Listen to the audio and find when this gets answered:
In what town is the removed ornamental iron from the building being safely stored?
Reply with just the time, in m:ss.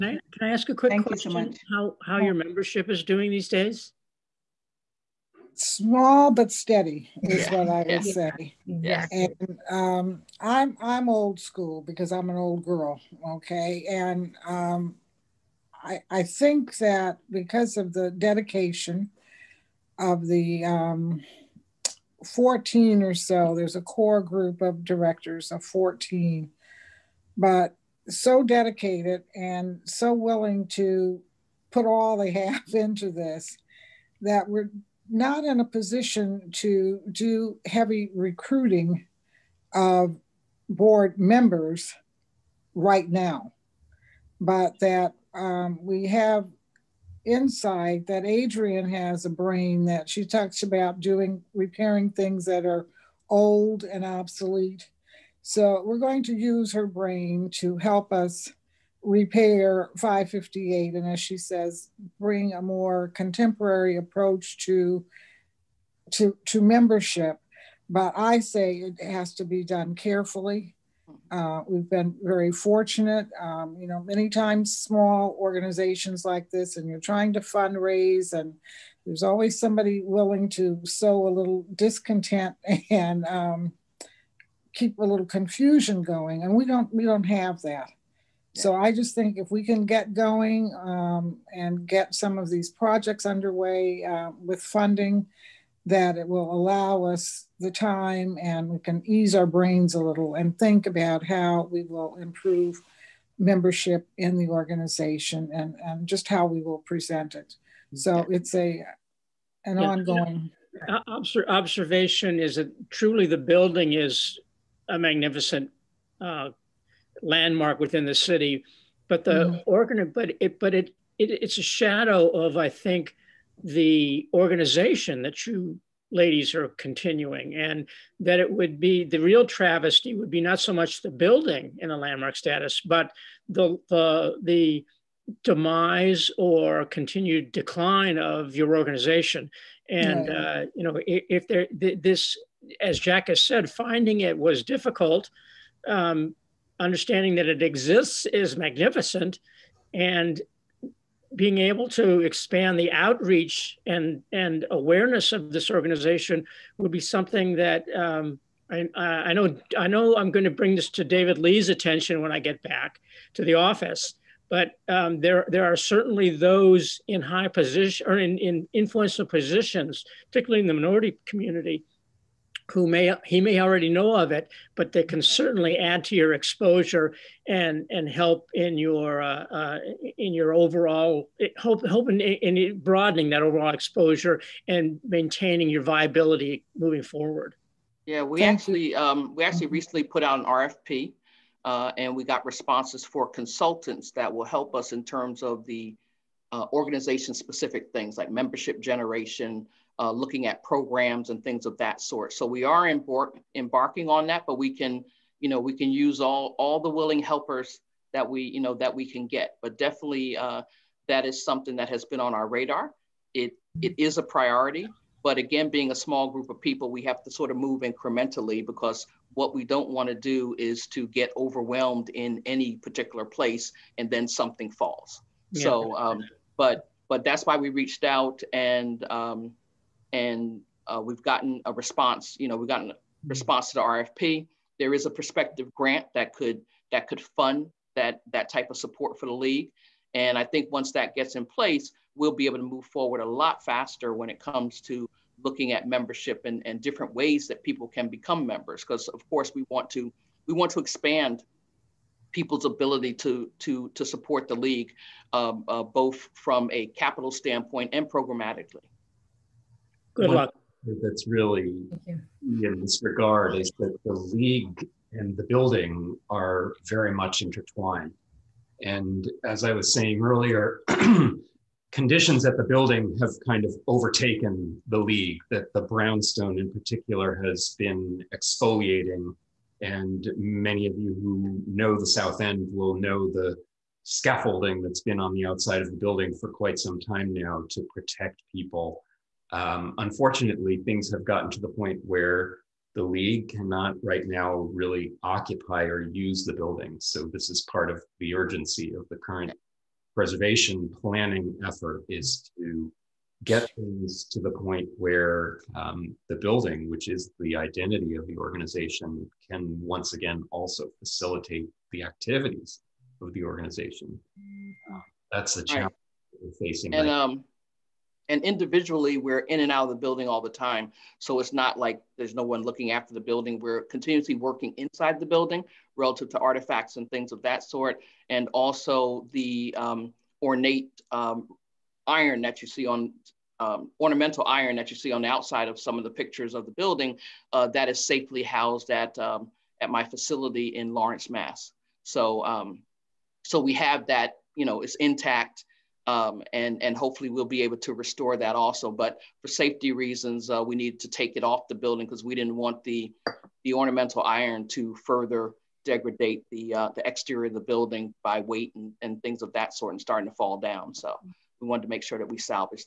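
5:40.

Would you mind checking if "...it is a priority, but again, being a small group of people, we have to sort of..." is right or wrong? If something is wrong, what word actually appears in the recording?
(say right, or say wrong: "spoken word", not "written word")
right.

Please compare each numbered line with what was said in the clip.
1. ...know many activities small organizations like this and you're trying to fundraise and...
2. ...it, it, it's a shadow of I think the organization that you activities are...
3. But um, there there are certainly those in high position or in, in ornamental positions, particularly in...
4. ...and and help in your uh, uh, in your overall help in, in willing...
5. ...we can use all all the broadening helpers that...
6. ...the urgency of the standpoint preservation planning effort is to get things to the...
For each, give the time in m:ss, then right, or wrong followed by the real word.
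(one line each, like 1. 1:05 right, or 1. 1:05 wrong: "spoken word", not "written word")
1. 1:13 wrong: "times", not "activities"
2. 2:00 wrong: "ladies", not "activities"
3. 2:44 wrong: "influential", not "ornamental"
4. 2:57 wrong: "broadening", not "willing"
5. 3:25 wrong: "willing", not "broadening"
6. 4:58 wrong: "current", not "standpoint".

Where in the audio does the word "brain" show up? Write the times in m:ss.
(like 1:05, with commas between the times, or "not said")
0:49, 0:56, 1:39.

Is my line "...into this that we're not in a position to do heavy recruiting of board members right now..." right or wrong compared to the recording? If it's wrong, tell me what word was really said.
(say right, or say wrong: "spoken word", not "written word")
right.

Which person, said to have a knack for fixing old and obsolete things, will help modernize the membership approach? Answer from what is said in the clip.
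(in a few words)
Adrian.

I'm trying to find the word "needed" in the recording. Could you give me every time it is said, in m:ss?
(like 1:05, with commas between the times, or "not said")
5:50.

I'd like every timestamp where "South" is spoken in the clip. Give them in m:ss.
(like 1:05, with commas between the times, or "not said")
4:42.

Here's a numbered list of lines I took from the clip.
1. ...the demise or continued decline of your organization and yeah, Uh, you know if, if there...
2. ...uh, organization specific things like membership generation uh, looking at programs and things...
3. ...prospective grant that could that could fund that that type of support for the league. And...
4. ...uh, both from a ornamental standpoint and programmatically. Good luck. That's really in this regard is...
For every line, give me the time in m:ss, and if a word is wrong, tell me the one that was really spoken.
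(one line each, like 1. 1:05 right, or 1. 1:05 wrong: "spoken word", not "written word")
1. 2:14 right
2. 3:16 right
3. 3:55 right
4. 4:15 wrong: "capital", not "ornamental".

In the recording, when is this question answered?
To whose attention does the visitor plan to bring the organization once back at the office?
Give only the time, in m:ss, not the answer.
2:41.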